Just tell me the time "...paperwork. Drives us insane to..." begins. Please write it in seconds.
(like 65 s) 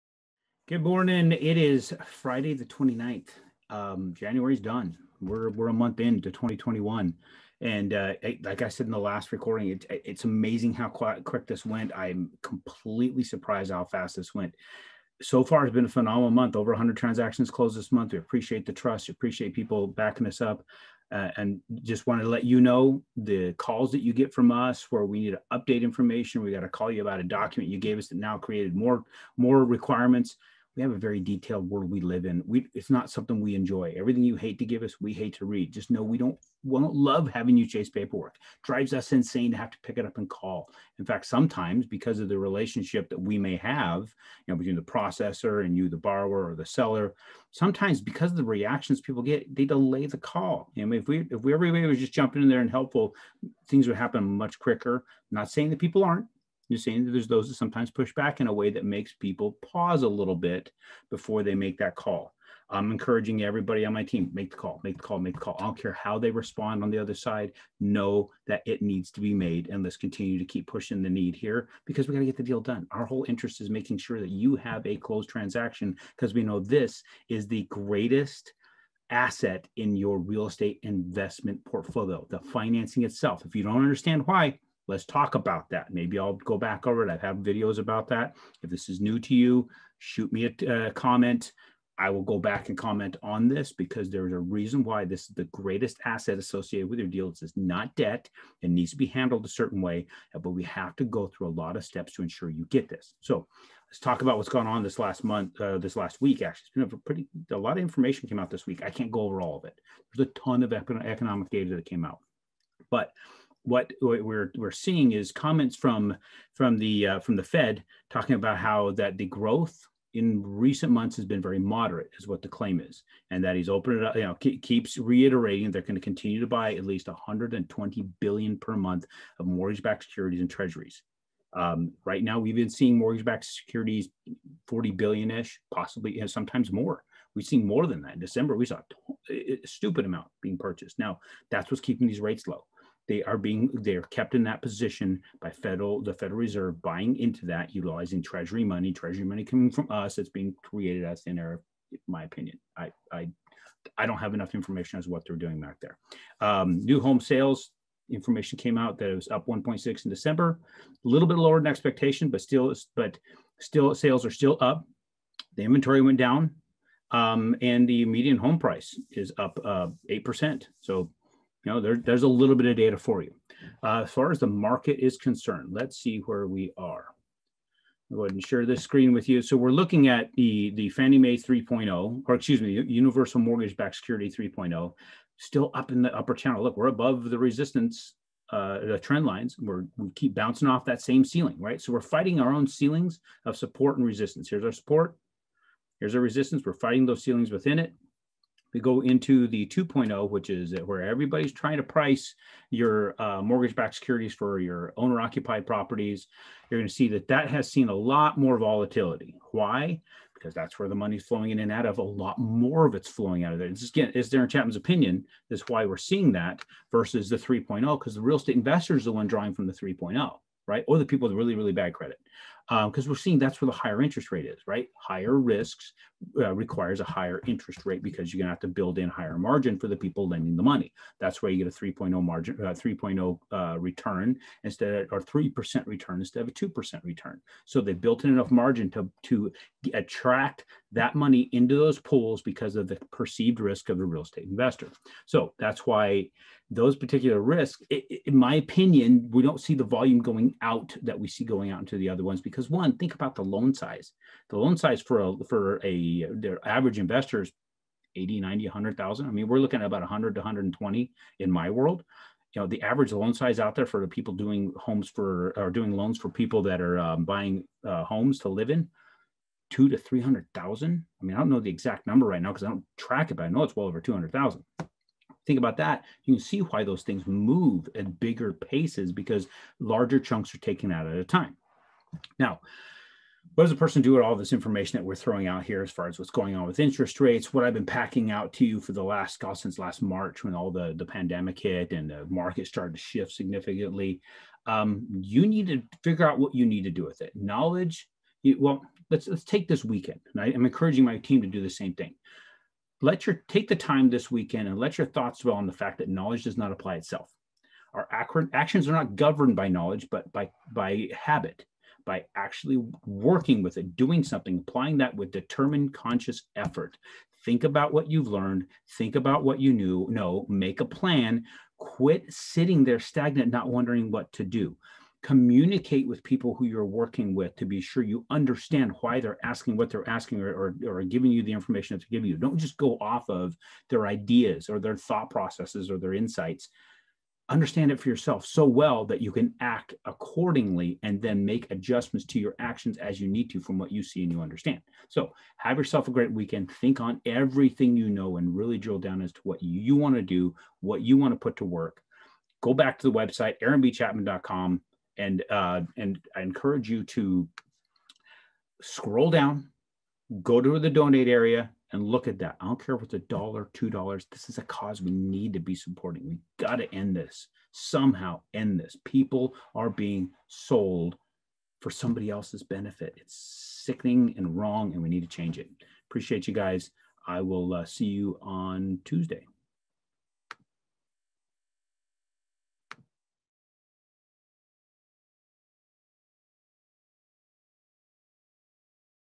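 37 s.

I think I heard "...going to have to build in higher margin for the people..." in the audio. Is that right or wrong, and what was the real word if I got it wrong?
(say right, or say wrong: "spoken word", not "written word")
right.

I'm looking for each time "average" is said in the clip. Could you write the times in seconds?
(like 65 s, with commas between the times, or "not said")
256 s, 262 s.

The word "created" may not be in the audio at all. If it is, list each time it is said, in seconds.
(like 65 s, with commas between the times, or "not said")
28 s, 150 s.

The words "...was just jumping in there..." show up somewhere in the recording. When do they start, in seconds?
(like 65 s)
51 s.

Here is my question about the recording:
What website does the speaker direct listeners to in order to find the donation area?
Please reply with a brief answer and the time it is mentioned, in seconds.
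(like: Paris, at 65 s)
aaronbchapman.com, at 353 s.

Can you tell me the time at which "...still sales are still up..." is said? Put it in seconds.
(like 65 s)
163 s.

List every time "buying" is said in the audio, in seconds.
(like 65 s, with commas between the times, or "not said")
146 s, 267 s.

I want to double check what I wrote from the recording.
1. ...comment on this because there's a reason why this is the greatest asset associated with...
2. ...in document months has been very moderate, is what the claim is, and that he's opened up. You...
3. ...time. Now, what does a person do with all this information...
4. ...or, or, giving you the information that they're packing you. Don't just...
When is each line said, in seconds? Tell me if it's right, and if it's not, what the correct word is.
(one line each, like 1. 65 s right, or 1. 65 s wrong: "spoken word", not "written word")
1. 92 s right
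2. 120 s wrong: "recent", not "document"
3. 281 s right
4. 330 s wrong: "giving", not "packing".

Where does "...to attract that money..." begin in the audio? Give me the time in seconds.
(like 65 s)
239 s.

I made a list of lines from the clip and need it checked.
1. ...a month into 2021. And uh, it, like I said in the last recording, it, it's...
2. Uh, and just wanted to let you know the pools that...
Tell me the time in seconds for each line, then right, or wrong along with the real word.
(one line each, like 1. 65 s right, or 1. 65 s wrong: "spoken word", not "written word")
1. 5 s right
2. 21 s wrong: "calls", not "pools".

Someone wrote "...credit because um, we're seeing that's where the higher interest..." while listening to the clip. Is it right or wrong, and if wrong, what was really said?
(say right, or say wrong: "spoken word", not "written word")
right.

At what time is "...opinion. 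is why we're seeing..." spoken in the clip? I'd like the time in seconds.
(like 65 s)
214 s.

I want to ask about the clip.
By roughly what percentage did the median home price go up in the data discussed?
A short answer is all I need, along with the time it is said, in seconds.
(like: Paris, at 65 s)
8%, at 170 s.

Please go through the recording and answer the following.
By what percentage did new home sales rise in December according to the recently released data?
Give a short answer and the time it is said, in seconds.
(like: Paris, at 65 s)
1.6, at 159 s.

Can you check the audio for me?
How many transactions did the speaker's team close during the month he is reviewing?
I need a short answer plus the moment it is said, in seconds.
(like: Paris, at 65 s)
Over 100, at 16 s.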